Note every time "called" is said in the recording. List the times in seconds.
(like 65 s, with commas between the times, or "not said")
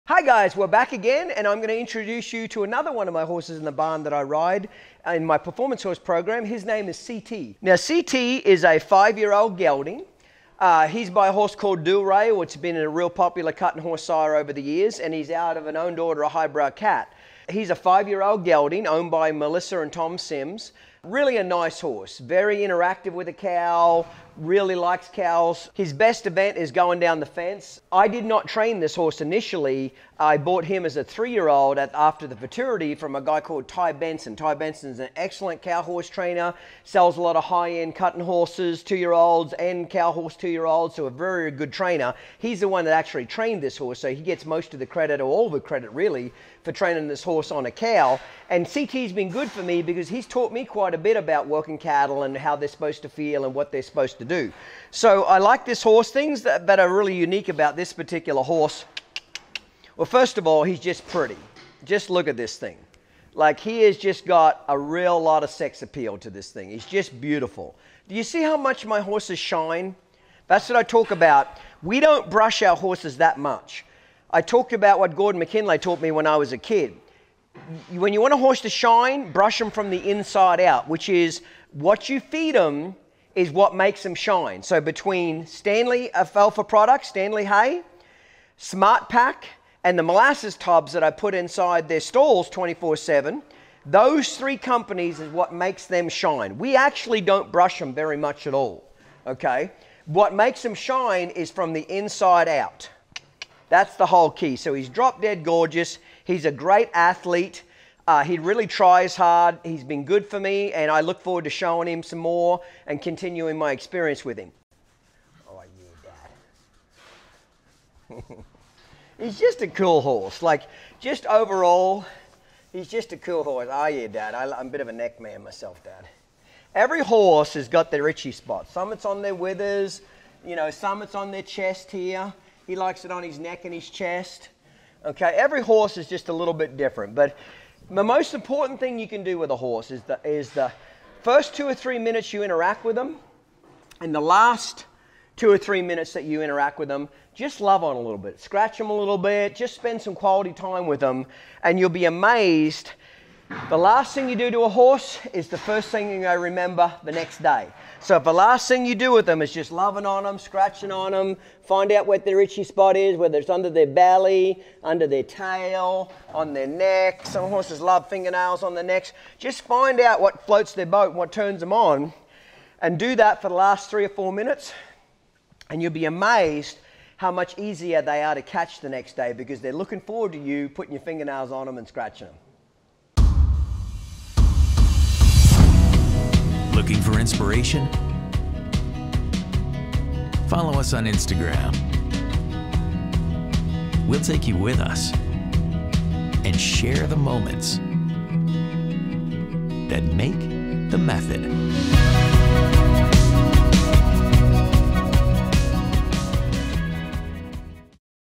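11 s, 33 s.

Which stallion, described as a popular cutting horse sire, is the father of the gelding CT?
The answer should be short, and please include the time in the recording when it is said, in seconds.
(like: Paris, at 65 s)
Dual Rey, at 11 s.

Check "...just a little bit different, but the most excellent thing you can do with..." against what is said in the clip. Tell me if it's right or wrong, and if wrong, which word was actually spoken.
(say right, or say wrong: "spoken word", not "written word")
wrong: "important", not "excellent".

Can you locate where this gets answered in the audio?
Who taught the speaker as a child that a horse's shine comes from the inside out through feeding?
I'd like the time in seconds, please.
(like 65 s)
75 s.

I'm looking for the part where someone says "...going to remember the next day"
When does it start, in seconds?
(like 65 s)
156 s.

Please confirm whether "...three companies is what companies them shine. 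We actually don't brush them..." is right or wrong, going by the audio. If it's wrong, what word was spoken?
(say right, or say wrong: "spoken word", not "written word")
wrong: "makes", not "companies".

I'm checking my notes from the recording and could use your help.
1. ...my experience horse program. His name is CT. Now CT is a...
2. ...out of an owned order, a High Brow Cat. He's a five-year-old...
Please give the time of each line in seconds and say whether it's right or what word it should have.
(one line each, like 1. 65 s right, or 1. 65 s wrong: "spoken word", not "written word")
1. 5 s wrong: "performance", not "experience"
2. 15 s right.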